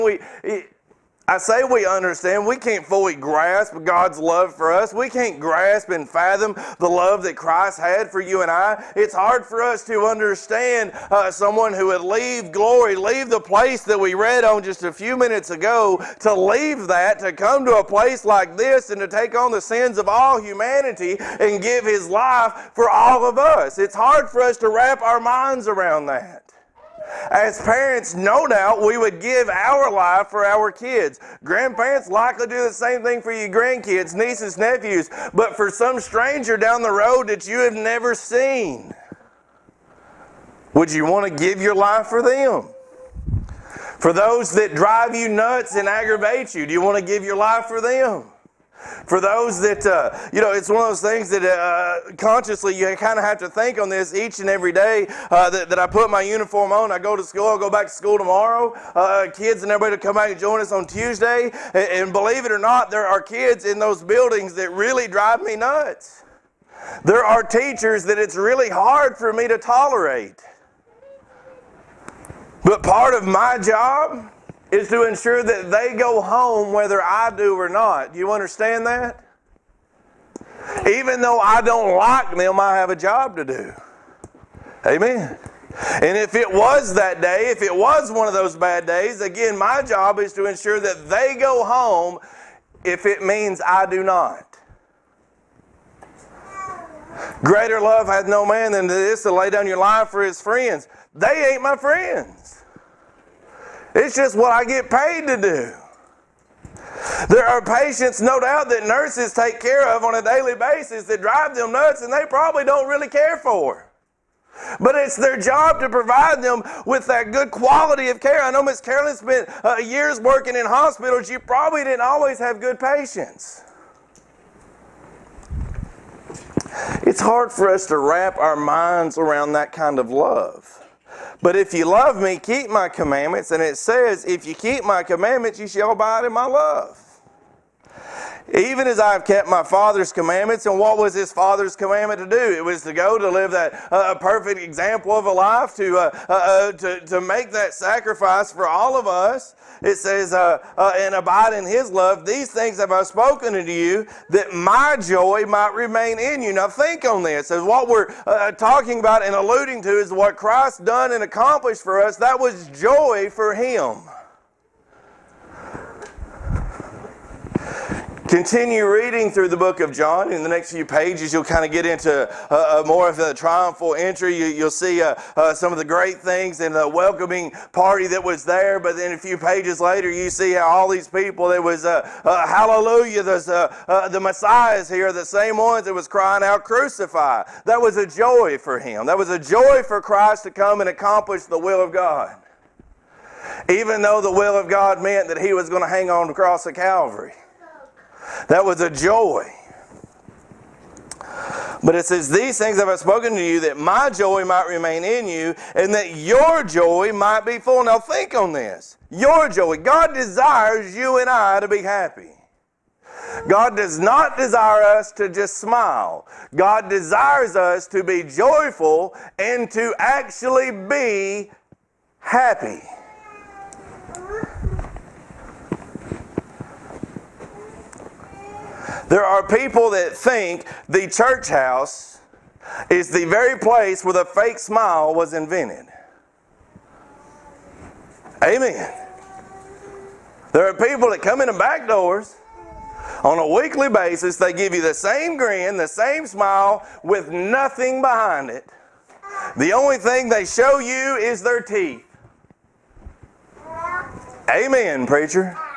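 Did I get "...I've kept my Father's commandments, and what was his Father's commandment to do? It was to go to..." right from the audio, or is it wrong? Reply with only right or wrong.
right.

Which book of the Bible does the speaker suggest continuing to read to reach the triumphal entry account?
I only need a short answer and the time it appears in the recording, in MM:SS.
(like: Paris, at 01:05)
John, at 02:49.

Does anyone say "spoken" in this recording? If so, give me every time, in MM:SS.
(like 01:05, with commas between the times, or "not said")
02:33, 03:22.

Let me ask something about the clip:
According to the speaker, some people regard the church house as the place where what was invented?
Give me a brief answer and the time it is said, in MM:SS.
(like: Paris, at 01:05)
the fake smile, at 03:54.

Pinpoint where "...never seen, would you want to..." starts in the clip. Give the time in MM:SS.
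00:37.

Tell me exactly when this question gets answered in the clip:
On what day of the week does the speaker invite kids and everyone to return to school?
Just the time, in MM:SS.
01:00.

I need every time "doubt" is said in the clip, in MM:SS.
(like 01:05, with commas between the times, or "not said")
00:28, 01:48.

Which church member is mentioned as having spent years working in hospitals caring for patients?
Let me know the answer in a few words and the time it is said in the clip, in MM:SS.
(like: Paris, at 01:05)
Miss Carolyn, at 01:58.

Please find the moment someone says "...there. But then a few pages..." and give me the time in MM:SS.
02:58.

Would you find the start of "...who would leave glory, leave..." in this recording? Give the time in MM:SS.
00:11.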